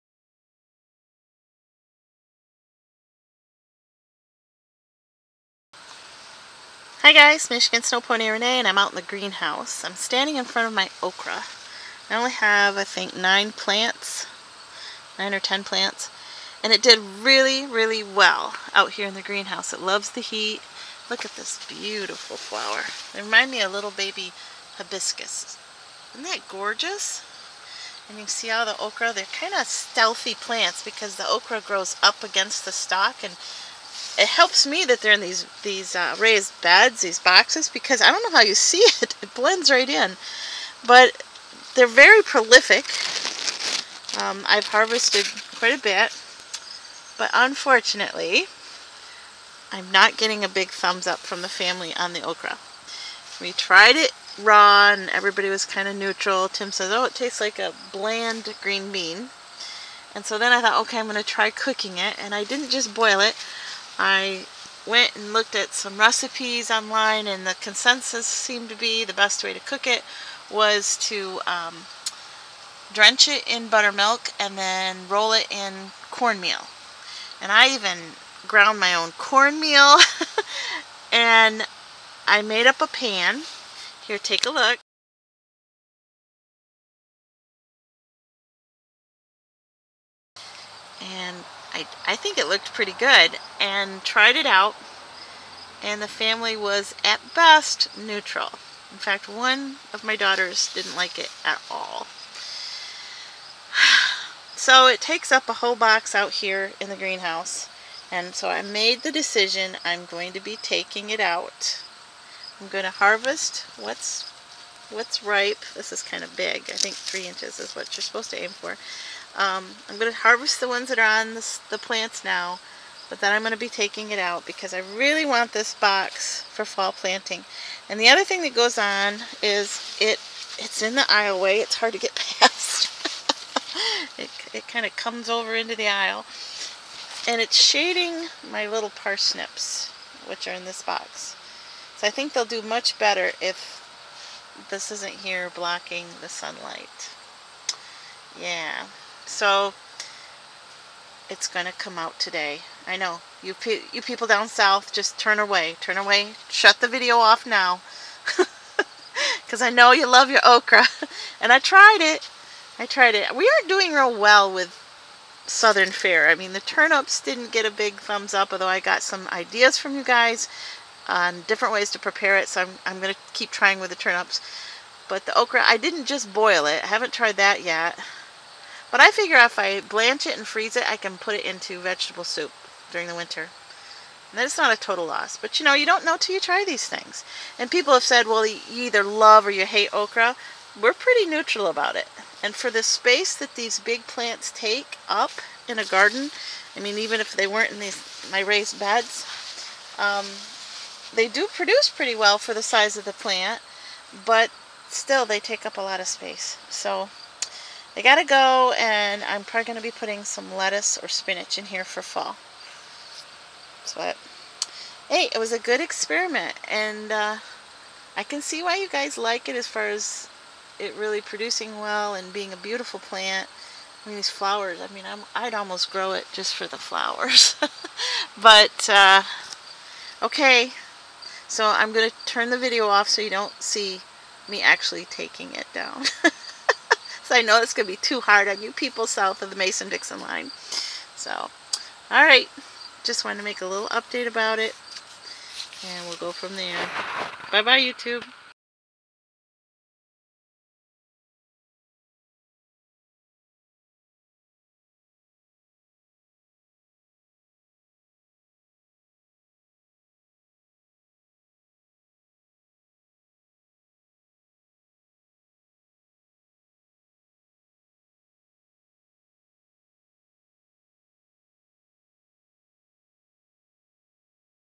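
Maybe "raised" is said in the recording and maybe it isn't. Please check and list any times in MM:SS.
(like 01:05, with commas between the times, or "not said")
00:36, 03:18.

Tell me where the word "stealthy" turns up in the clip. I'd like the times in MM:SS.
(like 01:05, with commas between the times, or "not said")
00:29.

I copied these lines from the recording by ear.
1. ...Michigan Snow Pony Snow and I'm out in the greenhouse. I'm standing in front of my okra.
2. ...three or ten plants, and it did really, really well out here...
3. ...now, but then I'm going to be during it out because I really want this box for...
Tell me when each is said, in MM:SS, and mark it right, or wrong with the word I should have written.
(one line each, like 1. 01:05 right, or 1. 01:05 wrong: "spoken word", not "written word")
1. 00:07 wrong: "Renee", not "Snow"
2. 00:15 wrong: "nine", not "three"
3. 02:02 wrong: "taking", not "during".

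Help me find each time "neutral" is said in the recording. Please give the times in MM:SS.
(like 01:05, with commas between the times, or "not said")
00:55, 01:37, 03:11.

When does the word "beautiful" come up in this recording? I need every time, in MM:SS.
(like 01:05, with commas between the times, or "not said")
00:21, 03:42.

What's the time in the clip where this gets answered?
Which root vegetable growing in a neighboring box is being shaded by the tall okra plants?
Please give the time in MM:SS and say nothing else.
02:18.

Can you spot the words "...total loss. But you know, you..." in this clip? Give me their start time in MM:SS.
03:04.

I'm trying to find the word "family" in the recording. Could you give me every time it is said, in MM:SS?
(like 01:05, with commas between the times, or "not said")
00:51, 01:36.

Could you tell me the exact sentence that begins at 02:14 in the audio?
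it it kind of comes over into the aisle.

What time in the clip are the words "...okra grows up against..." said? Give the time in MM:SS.
00:31.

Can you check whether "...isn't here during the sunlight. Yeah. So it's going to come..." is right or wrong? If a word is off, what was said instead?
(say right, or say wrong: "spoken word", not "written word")
wrong: "blocking", not "during".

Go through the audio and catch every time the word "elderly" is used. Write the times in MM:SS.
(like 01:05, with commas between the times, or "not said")
not said.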